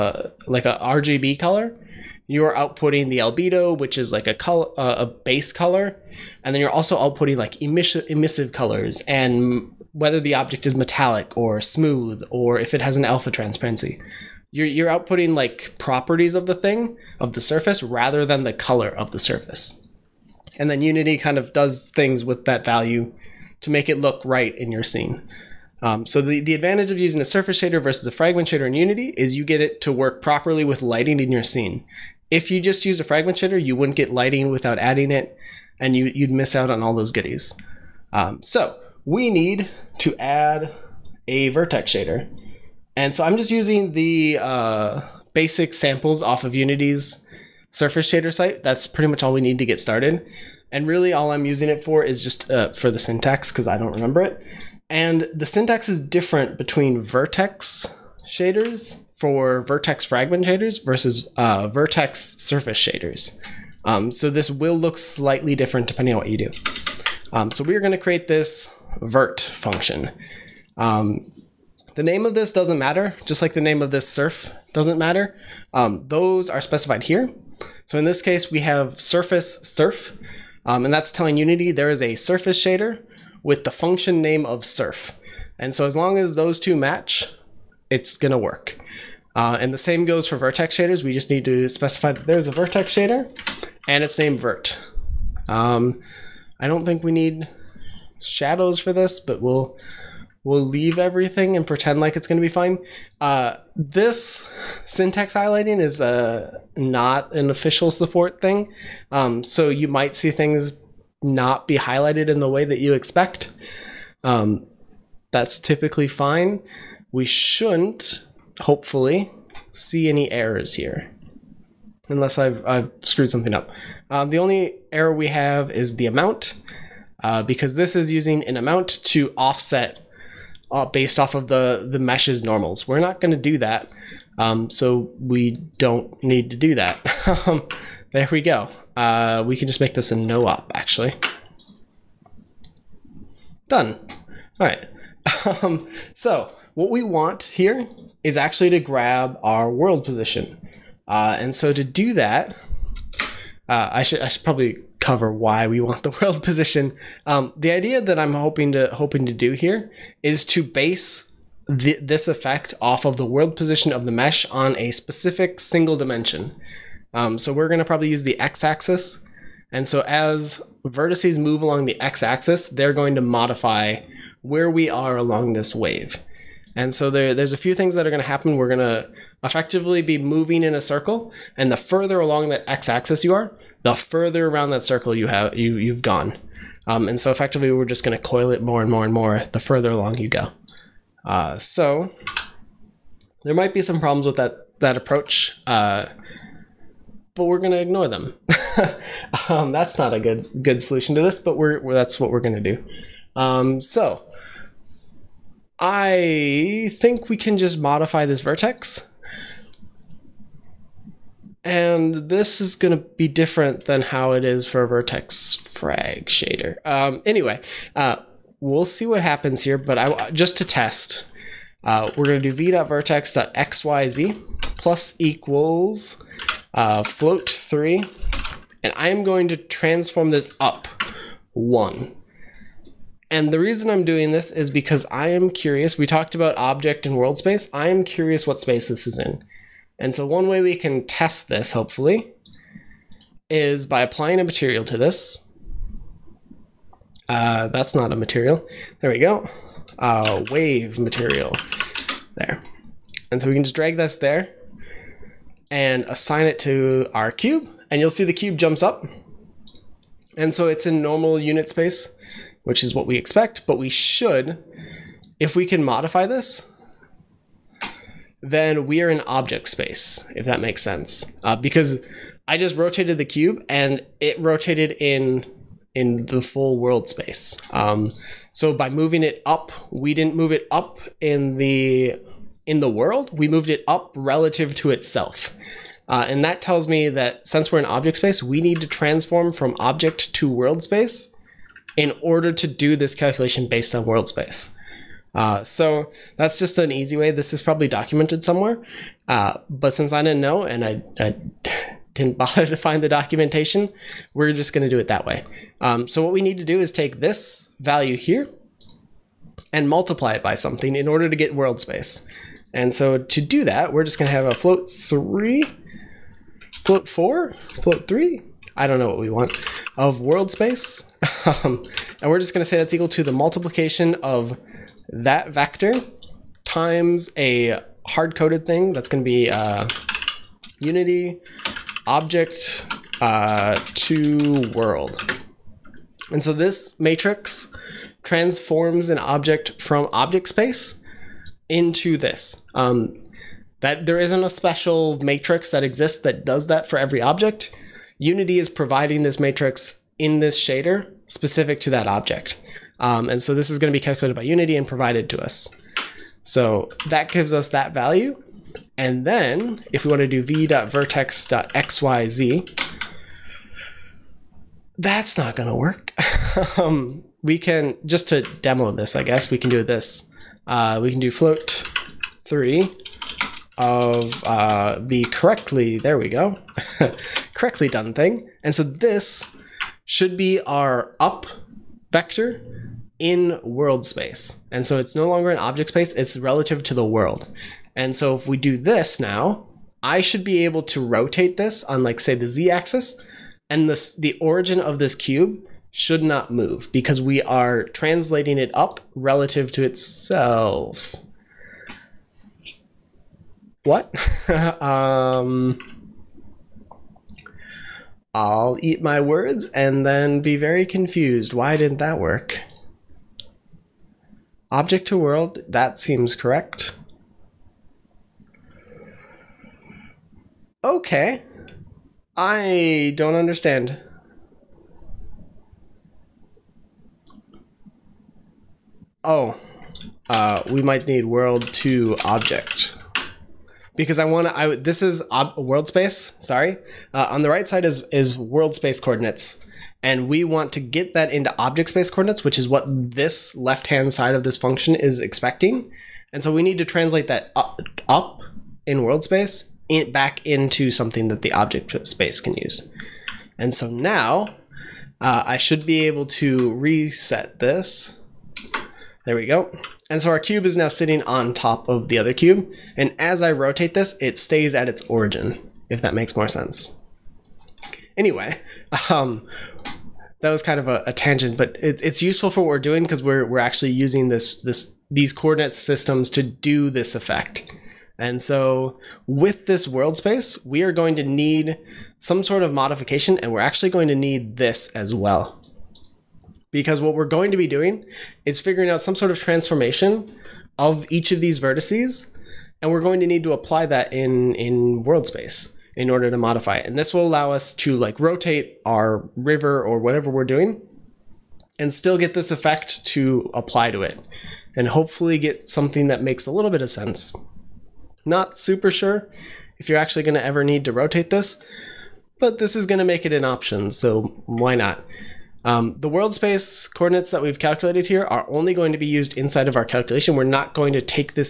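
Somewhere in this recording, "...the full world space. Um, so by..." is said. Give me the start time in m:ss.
4:36.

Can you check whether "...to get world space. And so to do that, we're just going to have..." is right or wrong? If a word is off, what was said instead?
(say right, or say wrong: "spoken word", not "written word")
right.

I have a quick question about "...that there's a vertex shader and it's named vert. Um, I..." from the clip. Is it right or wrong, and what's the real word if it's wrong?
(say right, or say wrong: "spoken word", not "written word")
right.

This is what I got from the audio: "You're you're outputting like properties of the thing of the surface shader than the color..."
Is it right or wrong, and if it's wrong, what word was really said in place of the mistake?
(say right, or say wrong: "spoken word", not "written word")
wrong: "rather", not "shader".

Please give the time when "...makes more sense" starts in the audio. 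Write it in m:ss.
7:46.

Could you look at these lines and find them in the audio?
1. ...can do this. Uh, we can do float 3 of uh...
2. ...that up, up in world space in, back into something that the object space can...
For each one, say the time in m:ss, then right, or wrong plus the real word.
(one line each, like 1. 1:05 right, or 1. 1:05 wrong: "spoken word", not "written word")
1. 6:09 right
2. 7:27 right.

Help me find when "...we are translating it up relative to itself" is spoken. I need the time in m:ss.
6:37.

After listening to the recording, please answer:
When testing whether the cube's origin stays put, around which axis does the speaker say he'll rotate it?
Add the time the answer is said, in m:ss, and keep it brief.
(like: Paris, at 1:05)
z axis, at 6:32.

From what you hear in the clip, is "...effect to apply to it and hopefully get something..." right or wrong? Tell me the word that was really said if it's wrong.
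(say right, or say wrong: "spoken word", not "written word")
right.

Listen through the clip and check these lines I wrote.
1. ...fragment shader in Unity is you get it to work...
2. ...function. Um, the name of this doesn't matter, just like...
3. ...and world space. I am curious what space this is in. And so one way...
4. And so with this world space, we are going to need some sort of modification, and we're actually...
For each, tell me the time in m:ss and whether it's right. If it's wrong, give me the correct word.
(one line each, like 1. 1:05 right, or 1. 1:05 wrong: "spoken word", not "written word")
1. 0:28 right
2. 1:09 right
3. 3:57 right
4. 7:58 right.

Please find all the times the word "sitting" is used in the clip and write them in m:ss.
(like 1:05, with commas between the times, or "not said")
7:40.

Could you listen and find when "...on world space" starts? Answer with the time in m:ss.
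4:53.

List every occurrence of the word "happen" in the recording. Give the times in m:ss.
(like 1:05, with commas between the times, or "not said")
2:58, 3:39.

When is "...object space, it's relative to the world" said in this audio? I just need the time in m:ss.
6:25.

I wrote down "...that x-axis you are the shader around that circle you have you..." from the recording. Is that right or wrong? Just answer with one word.
wrong.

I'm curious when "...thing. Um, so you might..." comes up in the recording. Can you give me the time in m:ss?
1:48.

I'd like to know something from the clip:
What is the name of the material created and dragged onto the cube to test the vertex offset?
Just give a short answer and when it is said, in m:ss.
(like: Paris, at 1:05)
wave material, at 4:10.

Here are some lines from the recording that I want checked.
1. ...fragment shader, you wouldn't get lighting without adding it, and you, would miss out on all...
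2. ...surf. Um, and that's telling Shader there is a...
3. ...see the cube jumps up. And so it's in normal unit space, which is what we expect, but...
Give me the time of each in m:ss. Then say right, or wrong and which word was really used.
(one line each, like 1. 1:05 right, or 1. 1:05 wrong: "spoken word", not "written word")
1. 0:33 right
2. 1:19 wrong: "Unity", not "Shader"
3. 4:18 right.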